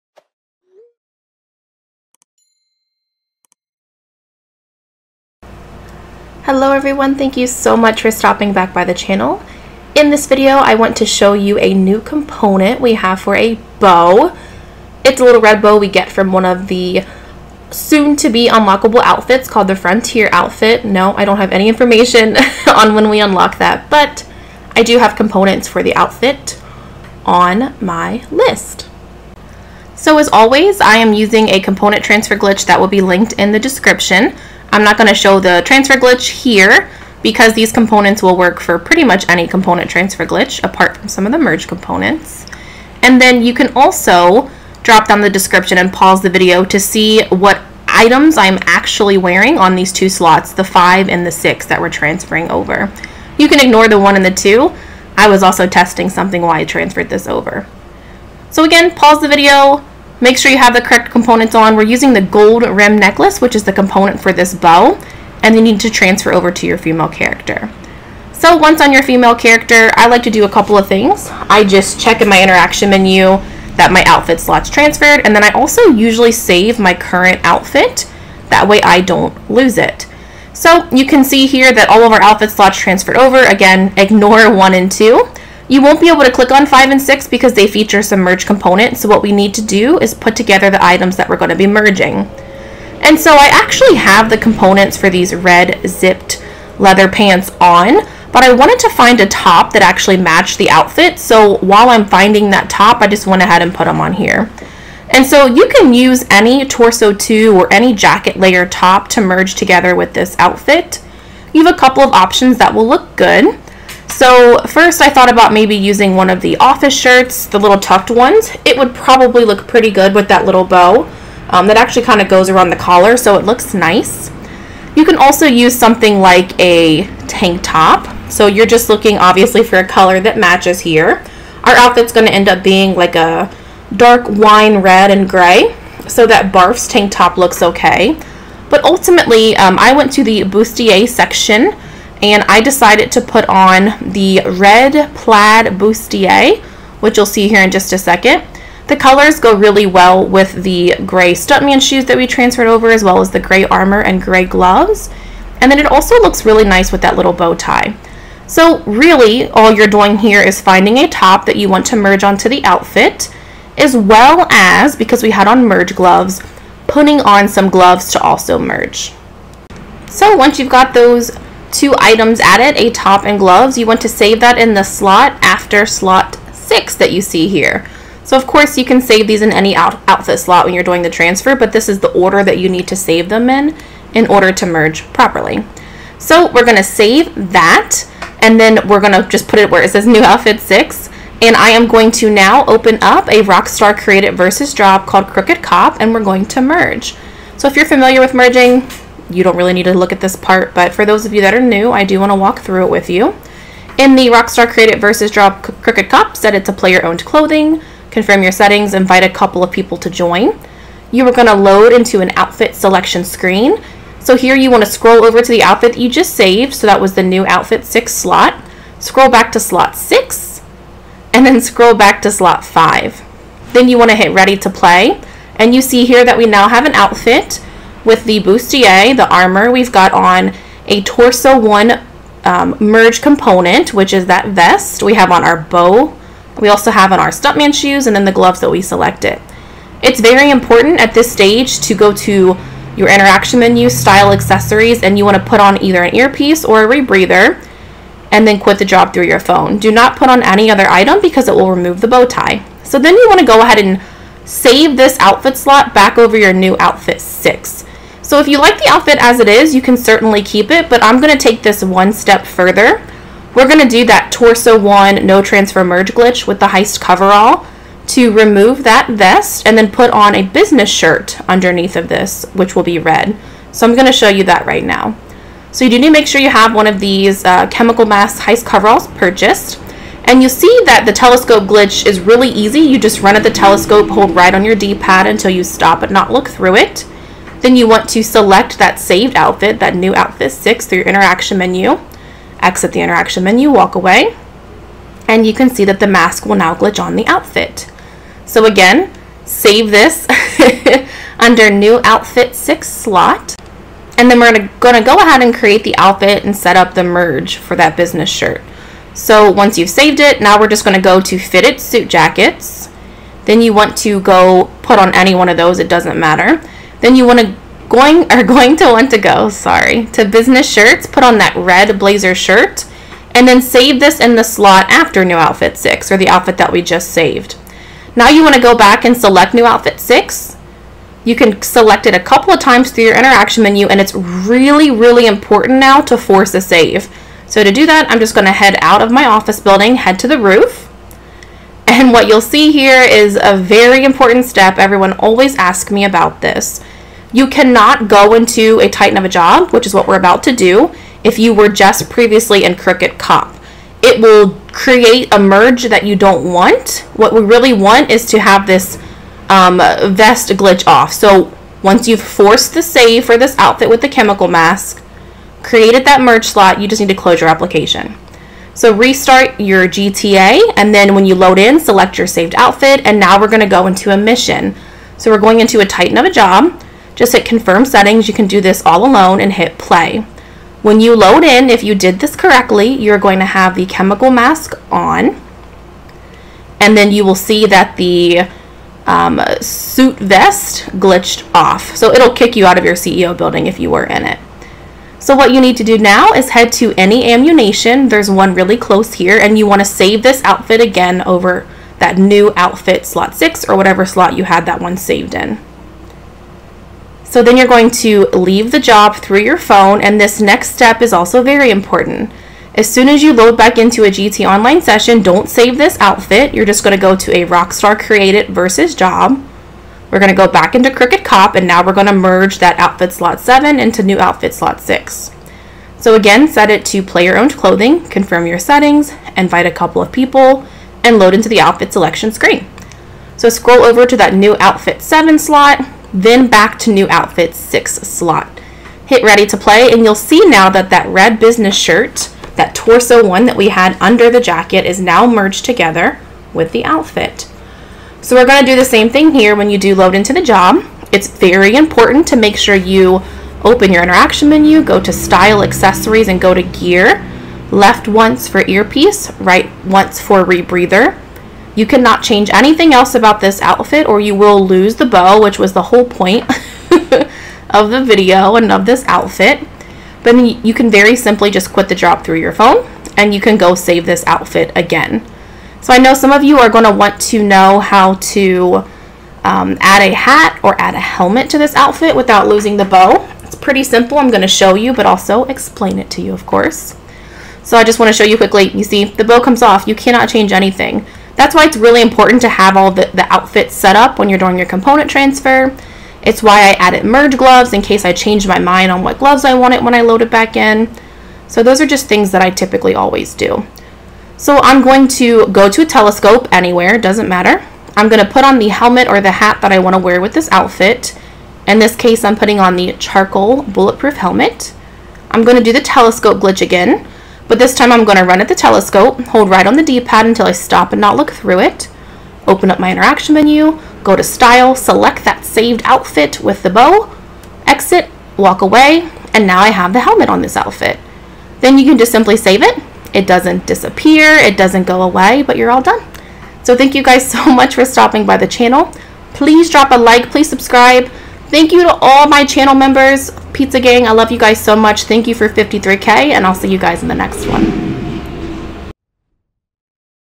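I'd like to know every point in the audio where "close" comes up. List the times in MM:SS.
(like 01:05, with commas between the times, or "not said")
06:07, 06:38.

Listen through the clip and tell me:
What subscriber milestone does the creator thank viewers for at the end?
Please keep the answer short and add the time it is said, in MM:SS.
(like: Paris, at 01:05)
53K, at 09:05.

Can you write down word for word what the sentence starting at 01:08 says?
So once on your female character, I like to do a couple of things.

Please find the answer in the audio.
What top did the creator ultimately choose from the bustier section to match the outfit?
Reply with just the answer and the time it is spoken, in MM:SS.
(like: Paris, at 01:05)
red plaid bustier, at 02:24.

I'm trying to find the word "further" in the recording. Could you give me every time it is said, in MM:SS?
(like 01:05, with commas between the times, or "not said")
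04:22.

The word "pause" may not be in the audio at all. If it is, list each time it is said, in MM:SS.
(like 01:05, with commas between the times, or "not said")
00:45, 00:58.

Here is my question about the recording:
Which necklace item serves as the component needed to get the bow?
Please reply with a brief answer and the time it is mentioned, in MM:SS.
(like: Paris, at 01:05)
gold rim necklace, at 01:02.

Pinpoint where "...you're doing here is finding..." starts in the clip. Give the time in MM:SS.
02:39.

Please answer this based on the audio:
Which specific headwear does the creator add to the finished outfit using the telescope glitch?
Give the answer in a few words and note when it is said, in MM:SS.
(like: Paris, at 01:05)
charcoal bulletproof helmet, at 08:32.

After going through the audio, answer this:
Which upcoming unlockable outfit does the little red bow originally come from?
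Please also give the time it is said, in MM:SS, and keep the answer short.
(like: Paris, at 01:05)
Frontier outfit, at 00:19.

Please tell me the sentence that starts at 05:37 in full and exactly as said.
So to do that, I'm just going to head out of my office building, head to the roof.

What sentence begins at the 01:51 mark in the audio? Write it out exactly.
You have a couple of options that will look good.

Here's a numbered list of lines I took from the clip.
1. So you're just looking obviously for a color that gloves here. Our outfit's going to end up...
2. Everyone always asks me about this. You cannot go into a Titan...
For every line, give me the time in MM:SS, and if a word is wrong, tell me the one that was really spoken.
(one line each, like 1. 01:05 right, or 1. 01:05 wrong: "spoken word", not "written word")
1. 02:08 wrong: "matches", not "gloves"
2. 05:44 right.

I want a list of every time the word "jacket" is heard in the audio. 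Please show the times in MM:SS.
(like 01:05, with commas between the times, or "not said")
01:47, 05:12, 07:24.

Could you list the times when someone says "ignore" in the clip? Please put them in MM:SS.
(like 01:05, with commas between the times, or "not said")
00:53, 01:23.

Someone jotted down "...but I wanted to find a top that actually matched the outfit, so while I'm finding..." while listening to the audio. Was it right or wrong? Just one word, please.
right.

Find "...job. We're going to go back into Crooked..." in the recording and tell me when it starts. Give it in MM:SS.
06:58.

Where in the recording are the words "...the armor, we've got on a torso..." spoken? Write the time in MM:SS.
03:49.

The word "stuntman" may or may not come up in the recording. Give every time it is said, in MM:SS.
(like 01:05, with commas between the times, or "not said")
02:31, 03:57.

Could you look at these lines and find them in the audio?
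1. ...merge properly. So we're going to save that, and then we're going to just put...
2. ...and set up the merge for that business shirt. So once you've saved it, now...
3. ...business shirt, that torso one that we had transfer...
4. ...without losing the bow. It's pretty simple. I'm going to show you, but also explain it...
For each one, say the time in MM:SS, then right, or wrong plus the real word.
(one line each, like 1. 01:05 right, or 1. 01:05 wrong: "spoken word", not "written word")
1. 03:04 right
2. 05:06 right
3. 07:21 wrong: "under", not "transfer"
4. 08:02 right.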